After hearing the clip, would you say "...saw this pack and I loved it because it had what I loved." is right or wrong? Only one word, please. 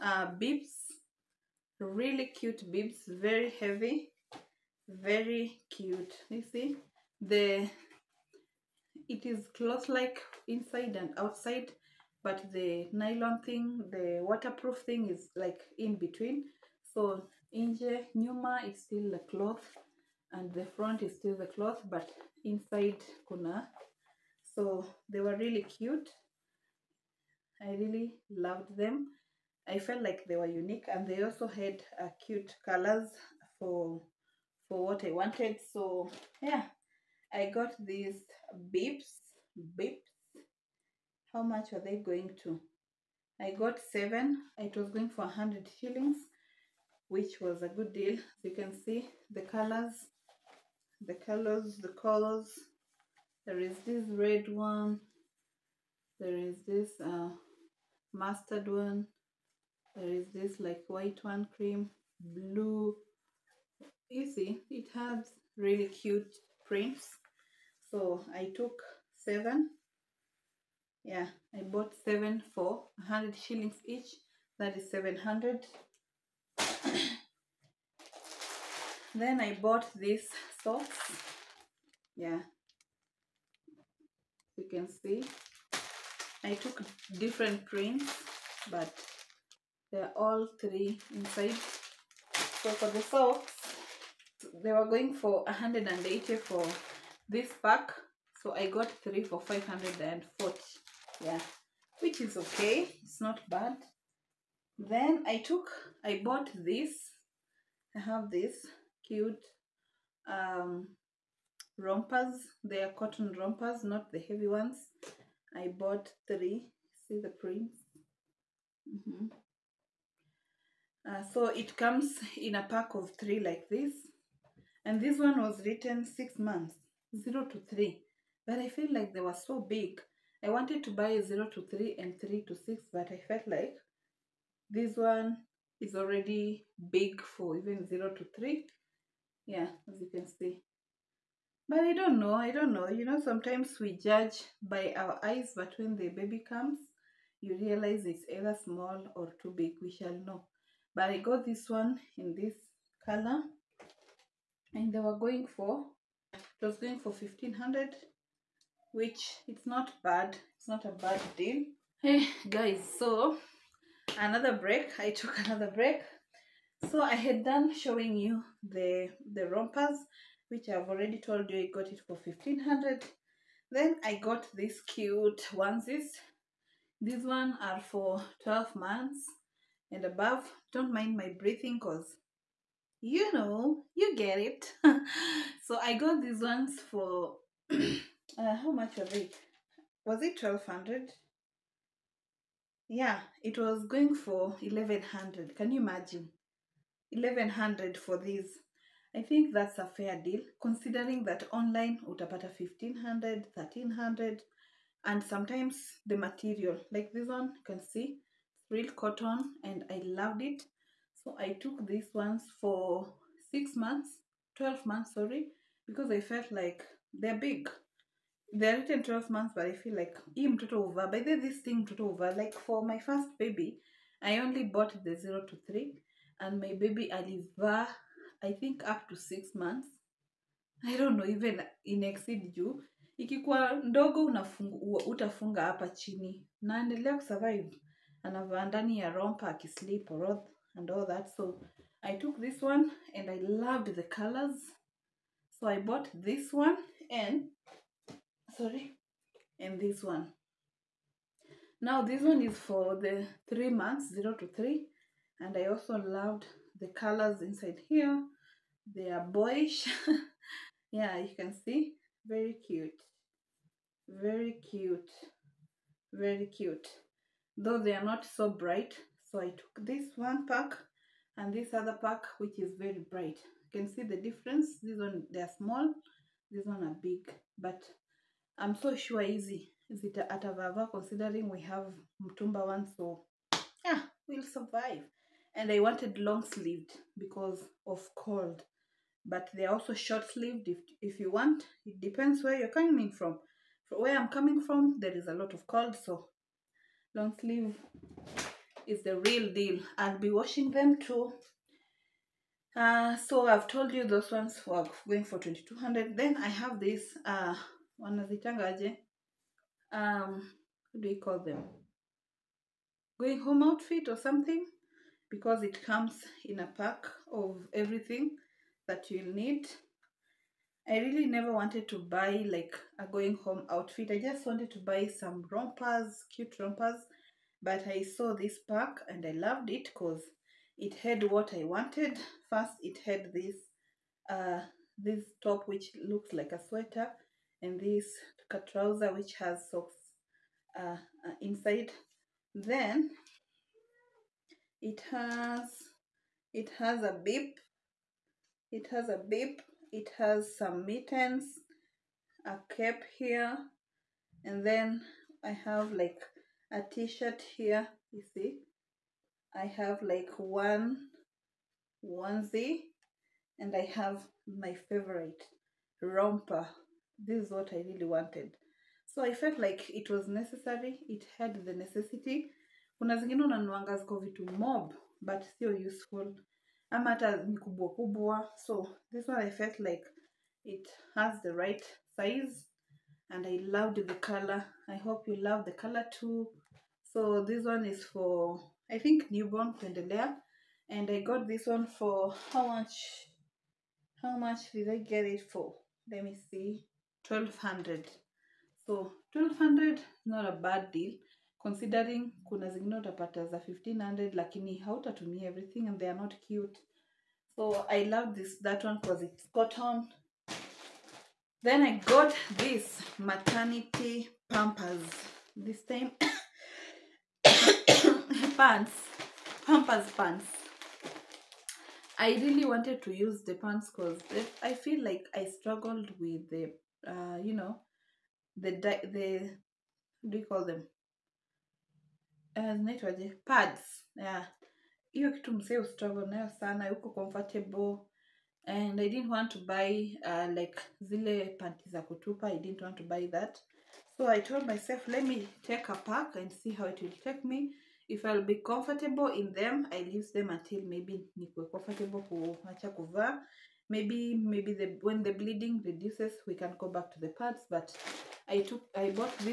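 wrong.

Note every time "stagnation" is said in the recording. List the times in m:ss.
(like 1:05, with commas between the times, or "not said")
not said.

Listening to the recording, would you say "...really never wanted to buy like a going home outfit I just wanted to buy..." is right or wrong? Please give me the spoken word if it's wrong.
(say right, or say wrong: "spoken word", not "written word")
right.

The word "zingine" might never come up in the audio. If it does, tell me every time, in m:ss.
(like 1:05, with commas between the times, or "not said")
6:13, 6:42.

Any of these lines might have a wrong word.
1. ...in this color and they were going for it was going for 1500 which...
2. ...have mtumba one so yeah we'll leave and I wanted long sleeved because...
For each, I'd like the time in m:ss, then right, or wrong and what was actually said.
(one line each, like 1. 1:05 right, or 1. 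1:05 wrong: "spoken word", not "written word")
1. 2:32 right
2. 4:41 wrong: "survive", not "leave".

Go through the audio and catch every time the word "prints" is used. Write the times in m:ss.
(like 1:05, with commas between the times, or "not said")
1:06, 1:27, 1:57.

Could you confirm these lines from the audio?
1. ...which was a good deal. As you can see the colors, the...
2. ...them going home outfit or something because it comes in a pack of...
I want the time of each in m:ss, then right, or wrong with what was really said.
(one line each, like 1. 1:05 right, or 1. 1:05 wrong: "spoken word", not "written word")
1. 0:47 right
2. 5:11 right.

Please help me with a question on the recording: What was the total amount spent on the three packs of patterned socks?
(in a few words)
540.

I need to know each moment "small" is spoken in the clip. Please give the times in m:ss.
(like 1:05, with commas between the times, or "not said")
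2:28, 4:35.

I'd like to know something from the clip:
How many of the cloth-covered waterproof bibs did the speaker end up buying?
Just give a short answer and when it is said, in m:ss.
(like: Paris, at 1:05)
7, at 0:43.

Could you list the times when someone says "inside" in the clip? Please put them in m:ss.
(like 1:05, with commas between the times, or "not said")
0:10, 0:22, 1:31, 4:17, 5:41.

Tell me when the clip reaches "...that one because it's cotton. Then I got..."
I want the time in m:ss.
6:48.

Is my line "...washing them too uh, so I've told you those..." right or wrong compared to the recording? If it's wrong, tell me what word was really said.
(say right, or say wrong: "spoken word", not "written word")
right.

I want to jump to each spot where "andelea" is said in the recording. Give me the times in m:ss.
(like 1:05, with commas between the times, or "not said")
3:56.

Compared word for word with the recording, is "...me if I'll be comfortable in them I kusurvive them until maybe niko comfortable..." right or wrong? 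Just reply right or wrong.
wrong.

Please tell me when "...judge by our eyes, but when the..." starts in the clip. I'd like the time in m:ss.
2:23.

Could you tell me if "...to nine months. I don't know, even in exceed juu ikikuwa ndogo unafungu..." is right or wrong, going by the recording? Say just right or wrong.
wrong.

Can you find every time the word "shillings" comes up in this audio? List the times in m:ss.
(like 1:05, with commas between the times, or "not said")
0:45, 1:13.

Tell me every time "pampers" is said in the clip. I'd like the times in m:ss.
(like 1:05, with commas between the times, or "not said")
6:54, 6:59.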